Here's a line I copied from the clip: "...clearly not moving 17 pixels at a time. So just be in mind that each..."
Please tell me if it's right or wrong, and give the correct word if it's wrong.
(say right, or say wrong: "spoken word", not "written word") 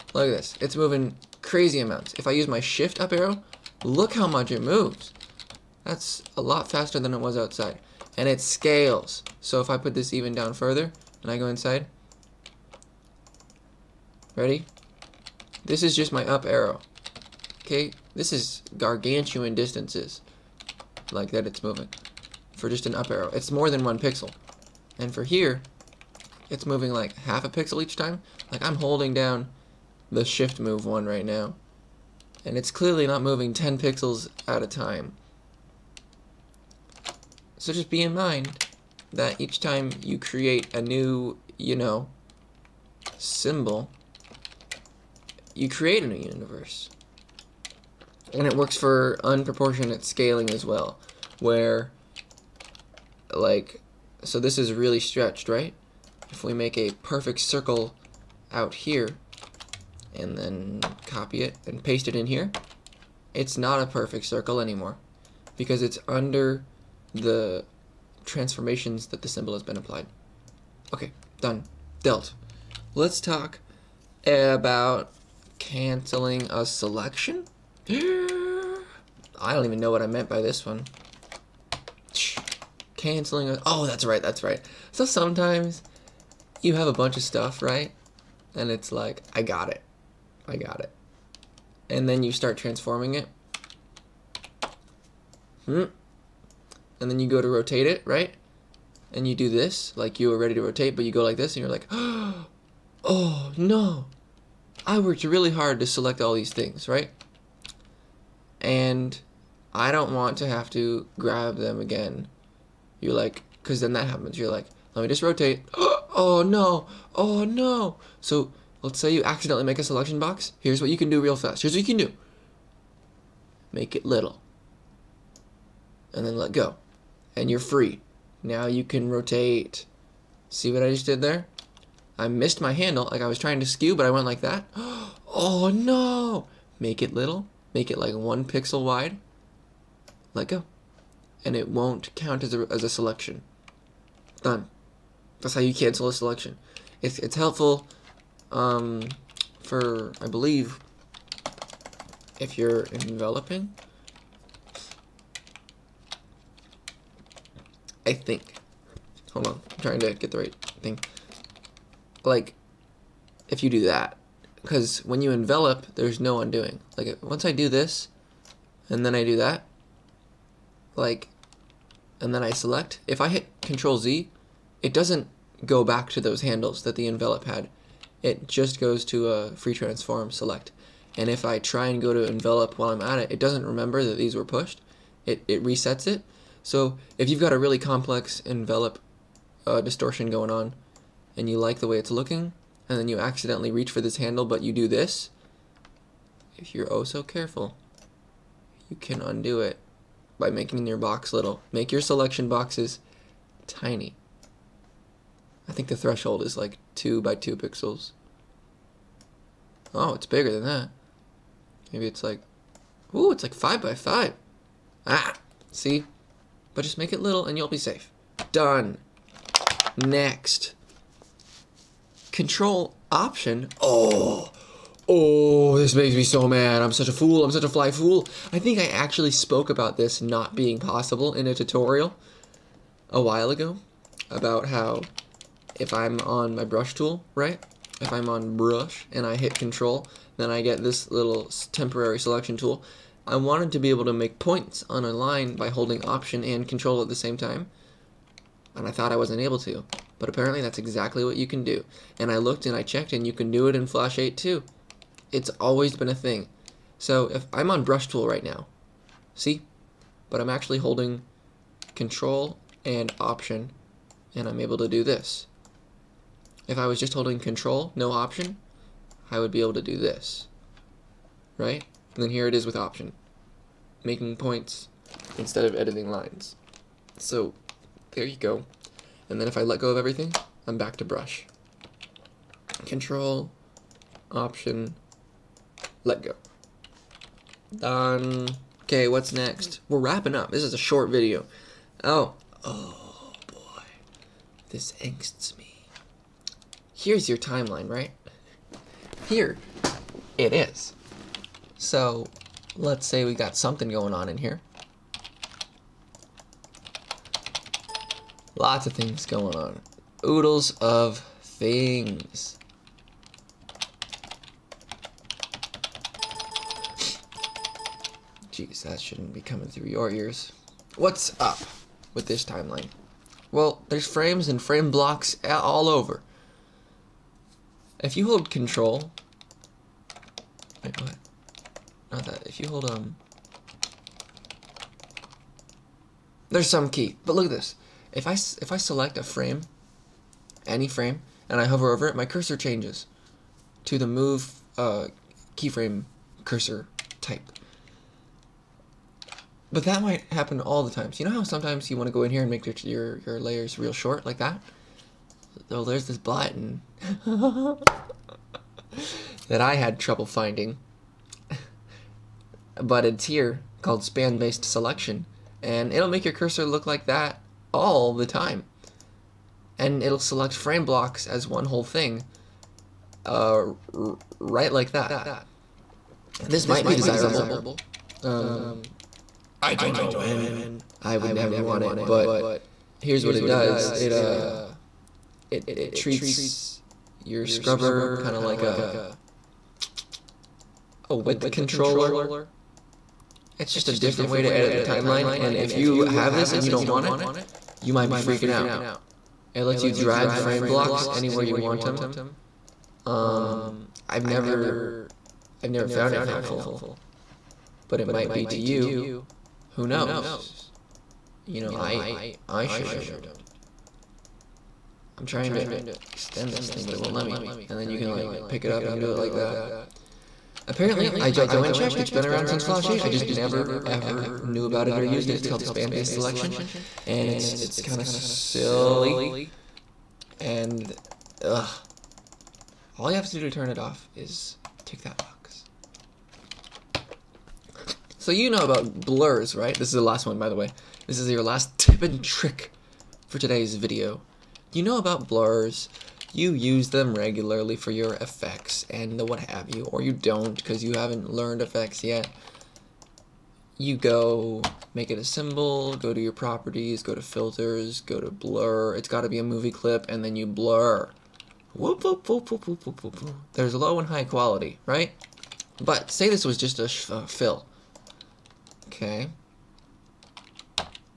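wrong: "10", not "17".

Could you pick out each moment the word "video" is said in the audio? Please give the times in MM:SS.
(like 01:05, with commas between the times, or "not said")
04:51, 07:23.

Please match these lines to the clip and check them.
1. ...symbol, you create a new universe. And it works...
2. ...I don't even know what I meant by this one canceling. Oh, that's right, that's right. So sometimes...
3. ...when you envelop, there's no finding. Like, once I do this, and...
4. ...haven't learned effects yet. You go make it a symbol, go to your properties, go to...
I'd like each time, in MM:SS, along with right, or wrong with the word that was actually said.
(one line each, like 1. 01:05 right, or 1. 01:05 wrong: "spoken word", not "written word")
1. 00:43 right
2. 01:17 right
3. 02:45 wrong: "undoing", not "finding"
4. 07:30 right.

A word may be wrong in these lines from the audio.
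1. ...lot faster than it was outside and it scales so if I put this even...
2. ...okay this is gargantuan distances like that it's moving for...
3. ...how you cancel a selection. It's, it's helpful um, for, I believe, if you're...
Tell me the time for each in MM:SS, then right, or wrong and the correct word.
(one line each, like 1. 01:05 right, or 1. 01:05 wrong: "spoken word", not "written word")
1. 00:06 right
2. 00:17 right
3. 02:25 right.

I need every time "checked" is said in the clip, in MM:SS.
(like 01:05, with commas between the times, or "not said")
04:12, 07:01.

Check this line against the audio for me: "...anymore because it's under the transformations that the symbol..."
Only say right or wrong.
right.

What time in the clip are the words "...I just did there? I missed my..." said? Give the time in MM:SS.
02:10.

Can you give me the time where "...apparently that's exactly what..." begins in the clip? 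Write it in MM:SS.
04:10.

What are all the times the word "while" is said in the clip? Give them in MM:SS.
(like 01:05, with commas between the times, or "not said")
03:02, 03:53.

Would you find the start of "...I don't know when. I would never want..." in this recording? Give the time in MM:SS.
06:19.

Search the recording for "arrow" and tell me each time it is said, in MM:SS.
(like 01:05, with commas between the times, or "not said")
00:03, 00:16, 00:23.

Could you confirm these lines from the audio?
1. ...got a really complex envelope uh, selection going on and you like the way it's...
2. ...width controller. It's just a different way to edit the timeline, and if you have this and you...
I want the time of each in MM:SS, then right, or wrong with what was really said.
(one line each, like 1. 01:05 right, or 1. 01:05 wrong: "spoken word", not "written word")
1. 03:07 wrong: "distortion", not "selection"
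2. 06:31 right.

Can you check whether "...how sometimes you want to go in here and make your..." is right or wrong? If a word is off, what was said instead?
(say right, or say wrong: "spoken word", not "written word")
right.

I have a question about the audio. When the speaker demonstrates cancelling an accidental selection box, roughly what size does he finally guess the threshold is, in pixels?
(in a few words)
5 by 5.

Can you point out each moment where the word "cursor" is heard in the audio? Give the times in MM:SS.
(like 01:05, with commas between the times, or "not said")
05:42, 05:46, 06:06.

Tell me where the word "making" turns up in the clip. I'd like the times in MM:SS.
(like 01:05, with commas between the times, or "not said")
03:20, 04:34.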